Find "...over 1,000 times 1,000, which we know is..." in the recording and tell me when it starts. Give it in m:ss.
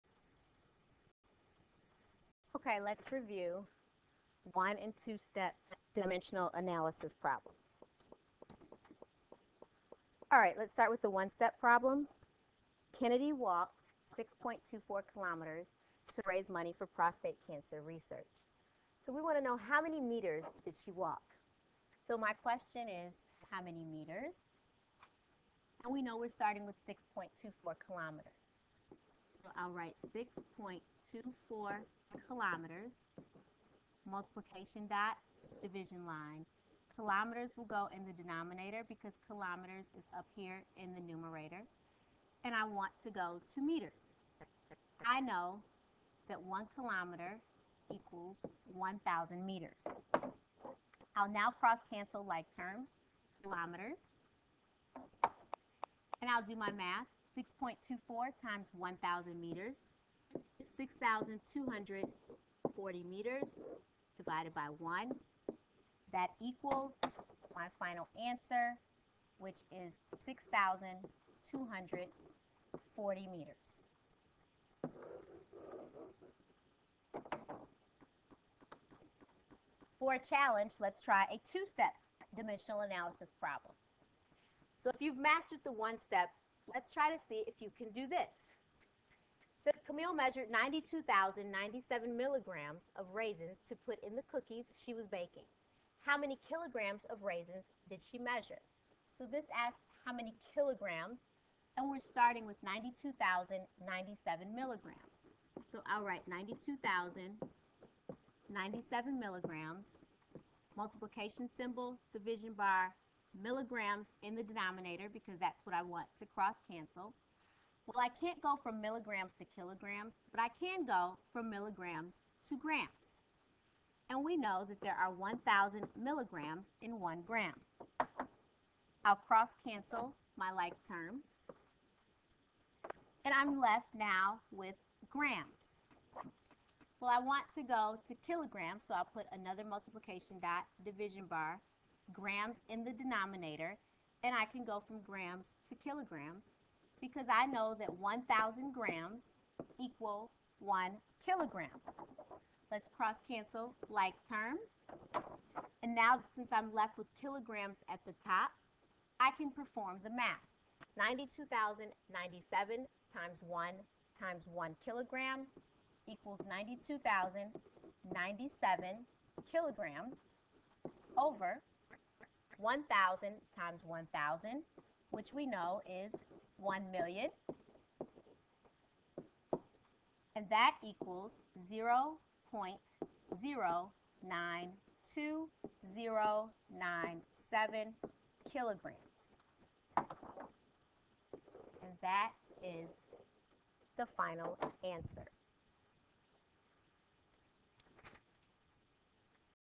2:51.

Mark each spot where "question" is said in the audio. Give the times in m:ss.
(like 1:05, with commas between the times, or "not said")
0:22.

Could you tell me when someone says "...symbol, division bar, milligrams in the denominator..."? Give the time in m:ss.
1:51.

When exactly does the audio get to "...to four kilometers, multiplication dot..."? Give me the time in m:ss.
0:31.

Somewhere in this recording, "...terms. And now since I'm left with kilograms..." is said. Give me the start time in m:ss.
2:34.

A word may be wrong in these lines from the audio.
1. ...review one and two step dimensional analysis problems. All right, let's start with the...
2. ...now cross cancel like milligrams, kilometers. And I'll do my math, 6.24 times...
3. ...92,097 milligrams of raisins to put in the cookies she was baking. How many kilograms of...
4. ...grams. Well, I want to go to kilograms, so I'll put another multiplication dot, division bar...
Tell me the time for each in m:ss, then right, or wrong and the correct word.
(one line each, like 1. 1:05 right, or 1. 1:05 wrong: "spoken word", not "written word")
1. 0:03 right
2. 0:51 wrong: "terms", not "milligrams"
3. 1:30 right
4. 2:15 right.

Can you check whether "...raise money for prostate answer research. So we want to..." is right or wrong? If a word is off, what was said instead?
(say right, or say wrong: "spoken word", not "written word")
wrong: "cancer", not "answer".